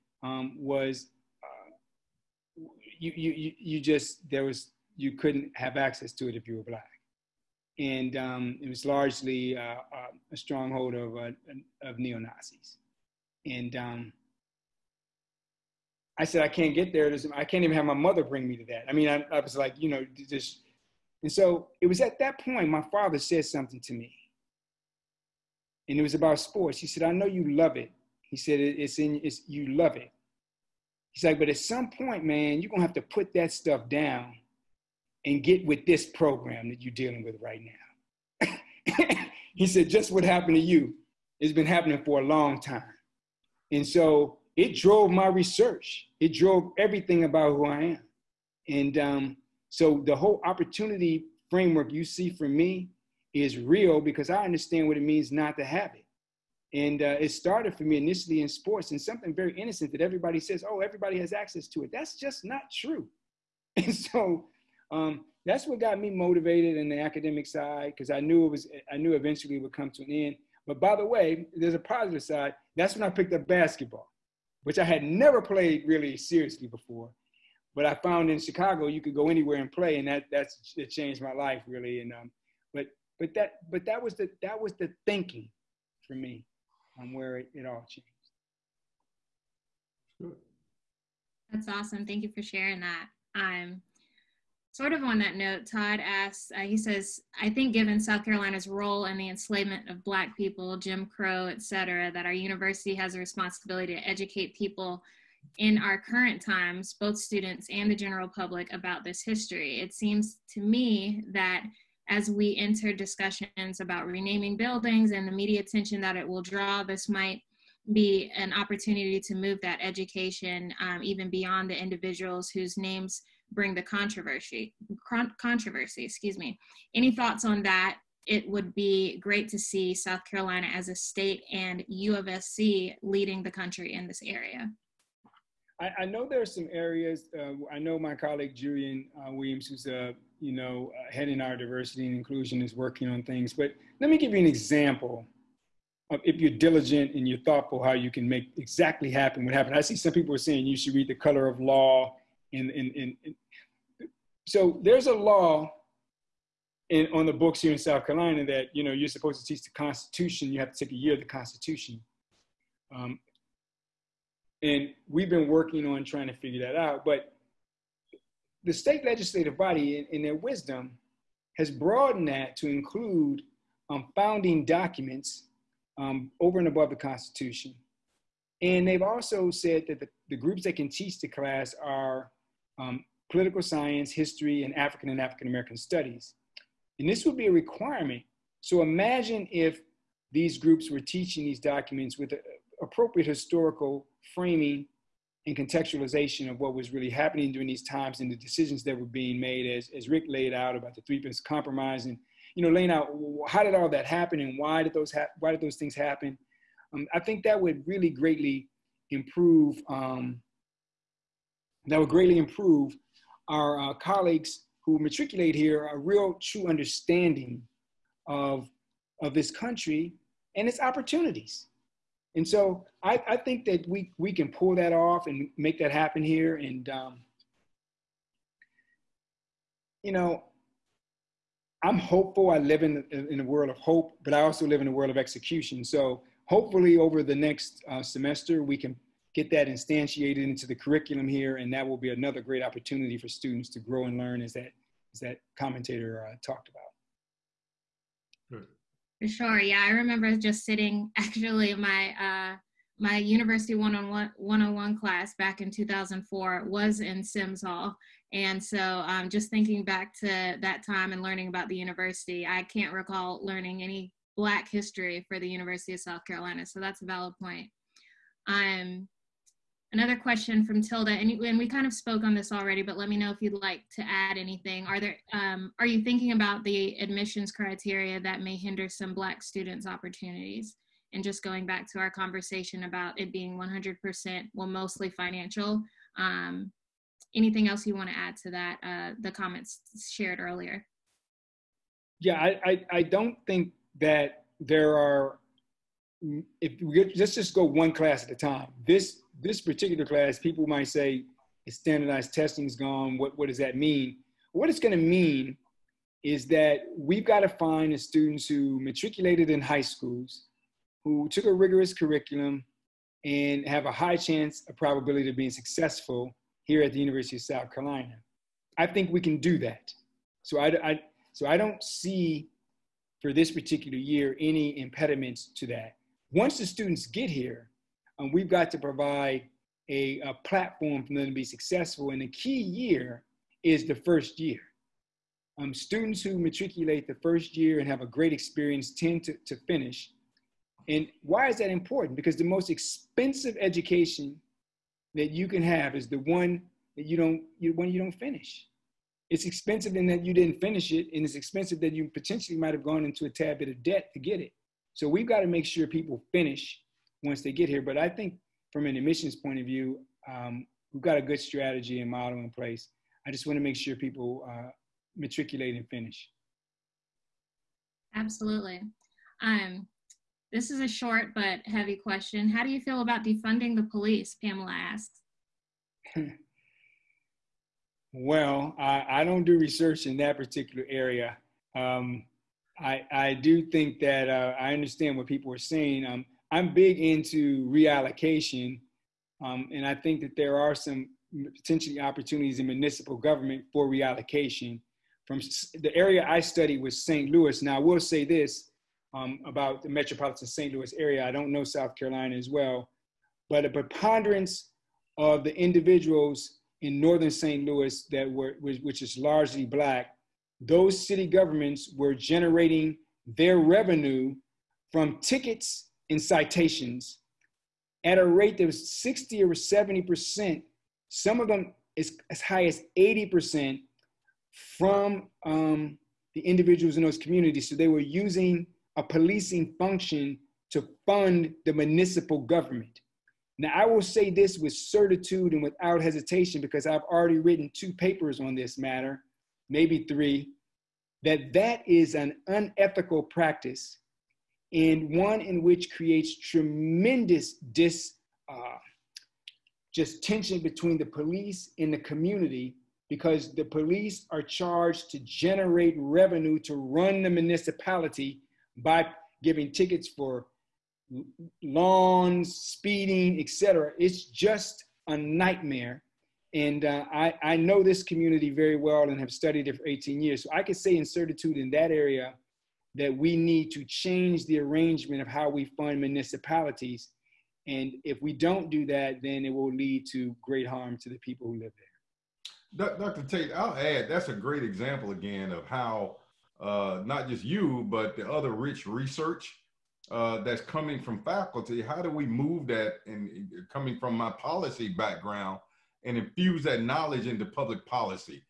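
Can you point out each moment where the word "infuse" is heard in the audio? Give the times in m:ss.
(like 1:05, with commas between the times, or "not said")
8:16.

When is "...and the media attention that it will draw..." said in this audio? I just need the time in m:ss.
1:55.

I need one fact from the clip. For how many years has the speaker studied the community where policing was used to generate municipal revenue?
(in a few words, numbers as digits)
18 years.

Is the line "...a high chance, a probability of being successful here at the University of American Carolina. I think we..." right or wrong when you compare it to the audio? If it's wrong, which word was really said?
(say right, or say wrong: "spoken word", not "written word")
wrong: "South", not "American".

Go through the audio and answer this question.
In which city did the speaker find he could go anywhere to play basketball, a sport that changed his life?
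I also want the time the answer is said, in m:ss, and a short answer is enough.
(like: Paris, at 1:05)
Chicago, at 1:18.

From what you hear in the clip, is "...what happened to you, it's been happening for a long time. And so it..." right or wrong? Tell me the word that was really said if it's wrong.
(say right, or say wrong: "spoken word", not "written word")
right.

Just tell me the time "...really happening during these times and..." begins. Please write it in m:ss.
3:16.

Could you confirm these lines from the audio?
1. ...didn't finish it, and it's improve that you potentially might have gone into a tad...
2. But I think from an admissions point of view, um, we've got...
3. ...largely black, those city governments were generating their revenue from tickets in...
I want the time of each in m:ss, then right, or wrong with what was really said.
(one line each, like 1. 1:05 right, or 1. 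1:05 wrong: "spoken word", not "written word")
1. 5:50 wrong: "expensive", not "improve"
2. 5:57 right
3. 6:49 right.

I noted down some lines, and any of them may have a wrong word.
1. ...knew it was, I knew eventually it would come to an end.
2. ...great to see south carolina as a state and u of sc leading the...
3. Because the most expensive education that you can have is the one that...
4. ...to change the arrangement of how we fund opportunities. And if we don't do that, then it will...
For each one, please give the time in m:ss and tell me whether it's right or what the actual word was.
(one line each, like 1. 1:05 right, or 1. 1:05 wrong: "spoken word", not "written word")
1. 1:08 right
2. 2:09 right
3. 5:42 right
4. 7:53 wrong: "municipalities", not "opportunities".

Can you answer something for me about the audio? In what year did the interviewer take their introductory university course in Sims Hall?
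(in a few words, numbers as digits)
2004.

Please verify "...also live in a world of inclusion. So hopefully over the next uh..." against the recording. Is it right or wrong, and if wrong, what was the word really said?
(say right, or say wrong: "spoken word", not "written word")
wrong: "execution", not "inclusion".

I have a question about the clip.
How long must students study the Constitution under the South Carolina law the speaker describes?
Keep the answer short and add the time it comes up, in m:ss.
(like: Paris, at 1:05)
A year, at 2:40.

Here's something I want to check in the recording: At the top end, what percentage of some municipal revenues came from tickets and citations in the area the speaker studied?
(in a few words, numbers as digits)
80%.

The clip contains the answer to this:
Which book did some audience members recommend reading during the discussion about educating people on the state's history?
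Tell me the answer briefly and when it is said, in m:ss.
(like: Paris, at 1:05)
The Color of Law, at 2:31.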